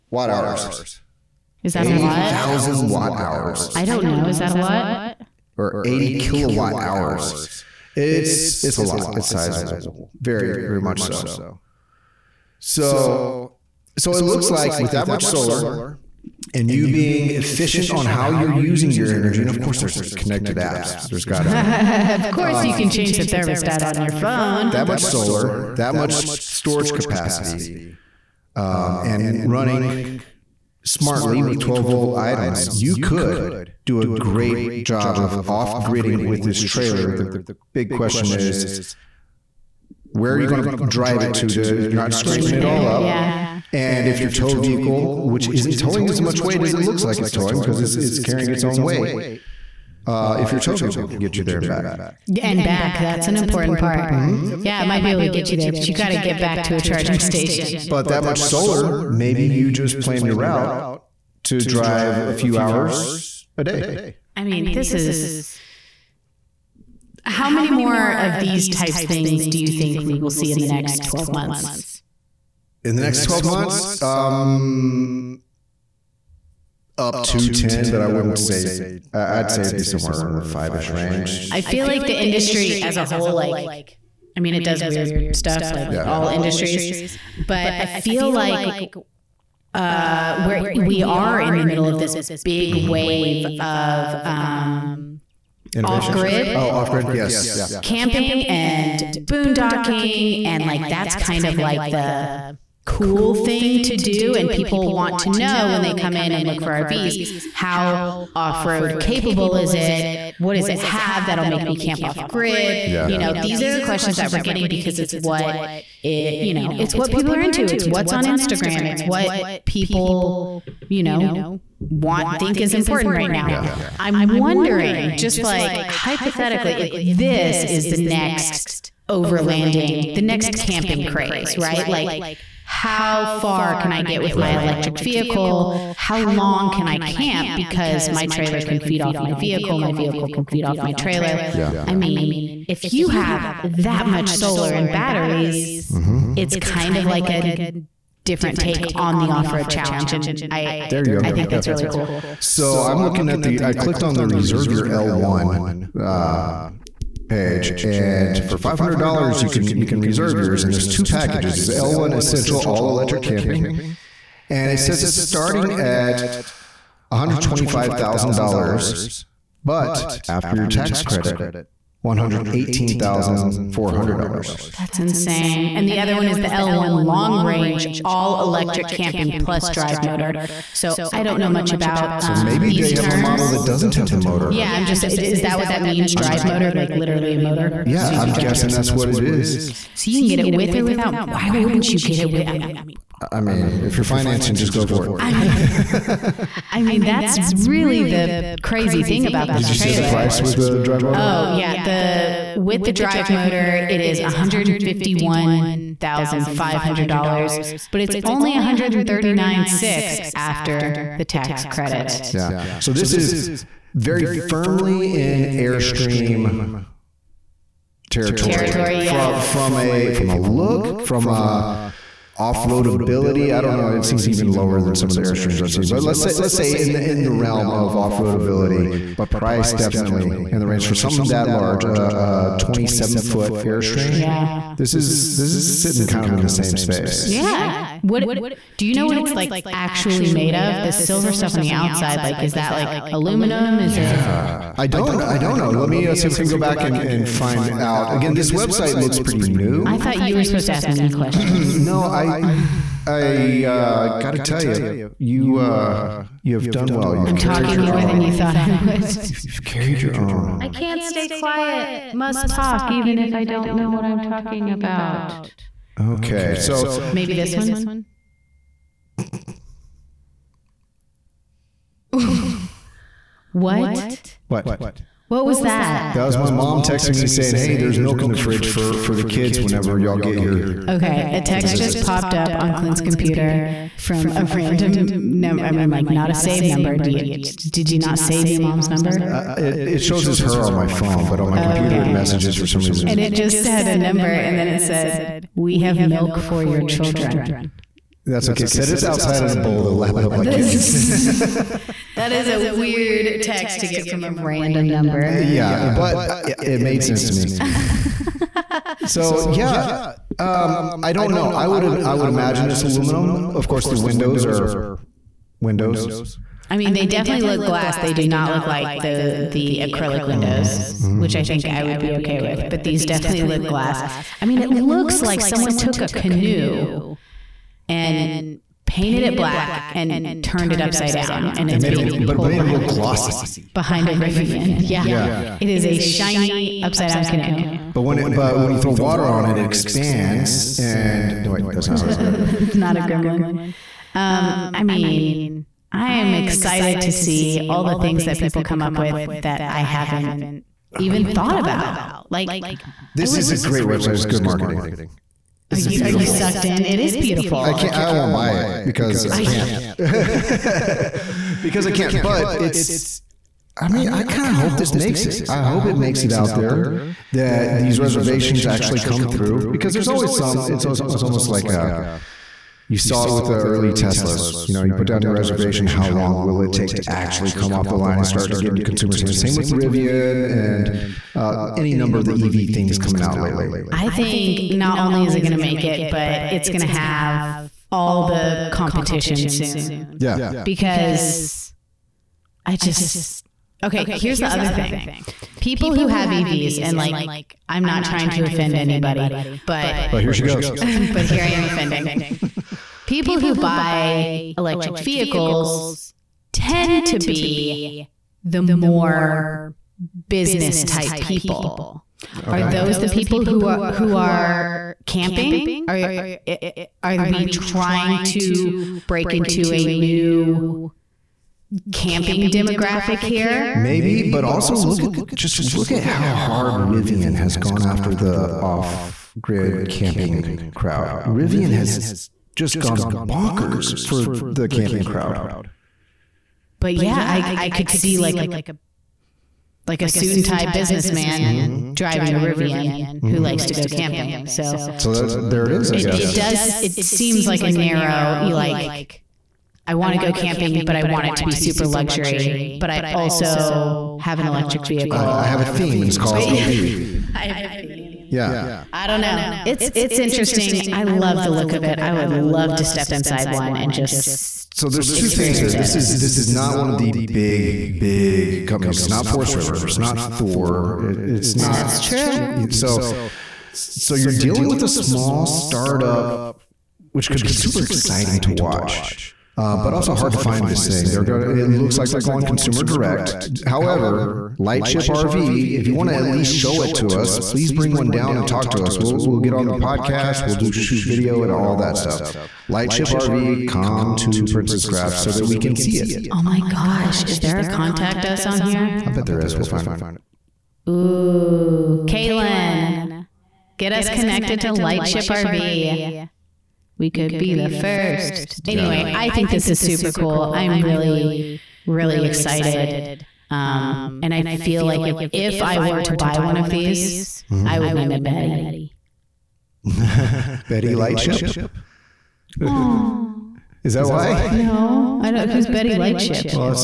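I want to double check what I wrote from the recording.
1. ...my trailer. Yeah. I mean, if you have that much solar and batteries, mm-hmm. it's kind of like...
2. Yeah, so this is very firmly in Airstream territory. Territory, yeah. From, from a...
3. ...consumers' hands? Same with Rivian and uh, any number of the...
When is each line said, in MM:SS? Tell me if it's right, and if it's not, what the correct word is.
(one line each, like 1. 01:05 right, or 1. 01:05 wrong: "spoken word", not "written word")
1. 02:20 right
2. 03:32 right
3. 06:18 right.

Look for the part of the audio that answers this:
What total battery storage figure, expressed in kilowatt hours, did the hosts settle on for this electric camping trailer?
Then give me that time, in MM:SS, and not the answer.
00:05.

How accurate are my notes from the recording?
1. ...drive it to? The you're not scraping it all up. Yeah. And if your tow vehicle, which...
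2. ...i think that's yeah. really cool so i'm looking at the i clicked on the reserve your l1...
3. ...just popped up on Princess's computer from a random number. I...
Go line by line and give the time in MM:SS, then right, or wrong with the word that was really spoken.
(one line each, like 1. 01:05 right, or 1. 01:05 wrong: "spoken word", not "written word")
1. 00:40 right
2. 02:31 right
3. 04:41 wrong: "Clint", not "Princess".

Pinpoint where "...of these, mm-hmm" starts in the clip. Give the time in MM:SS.
08:36.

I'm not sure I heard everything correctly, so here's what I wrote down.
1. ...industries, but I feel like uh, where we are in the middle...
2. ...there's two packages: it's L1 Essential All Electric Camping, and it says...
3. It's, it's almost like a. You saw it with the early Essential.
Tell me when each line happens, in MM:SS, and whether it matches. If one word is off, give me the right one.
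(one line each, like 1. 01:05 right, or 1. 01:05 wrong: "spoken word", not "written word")
1. 01:26 right
2. 02:40 right
3. 06:10 wrong: "Teslas", not "Essential".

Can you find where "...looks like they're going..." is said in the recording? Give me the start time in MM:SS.
08:01.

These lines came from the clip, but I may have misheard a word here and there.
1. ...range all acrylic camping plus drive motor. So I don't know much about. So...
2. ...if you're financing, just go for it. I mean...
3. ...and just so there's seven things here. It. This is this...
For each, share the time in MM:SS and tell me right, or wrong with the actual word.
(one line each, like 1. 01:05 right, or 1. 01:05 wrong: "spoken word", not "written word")
1. 02:57 wrong: "electric", not "acrylic"
2. 03:13 right
3. 07:43 wrong: "two", not "seven".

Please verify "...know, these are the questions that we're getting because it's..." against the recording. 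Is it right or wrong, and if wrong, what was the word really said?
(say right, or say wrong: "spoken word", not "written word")
right.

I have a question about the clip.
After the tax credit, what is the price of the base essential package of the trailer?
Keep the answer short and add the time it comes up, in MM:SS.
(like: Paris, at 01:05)
$118,400, at 02:52.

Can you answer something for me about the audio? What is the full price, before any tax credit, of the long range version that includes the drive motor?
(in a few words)
$151,500.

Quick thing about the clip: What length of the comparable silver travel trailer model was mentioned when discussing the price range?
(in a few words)
27 foot.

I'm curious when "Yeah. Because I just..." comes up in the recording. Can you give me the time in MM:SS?
06:30.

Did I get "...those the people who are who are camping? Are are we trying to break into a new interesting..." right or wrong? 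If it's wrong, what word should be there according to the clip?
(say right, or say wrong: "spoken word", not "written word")
wrong: "camping", not "interesting".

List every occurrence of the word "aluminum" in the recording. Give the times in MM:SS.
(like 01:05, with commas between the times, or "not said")
04:03, 05:12.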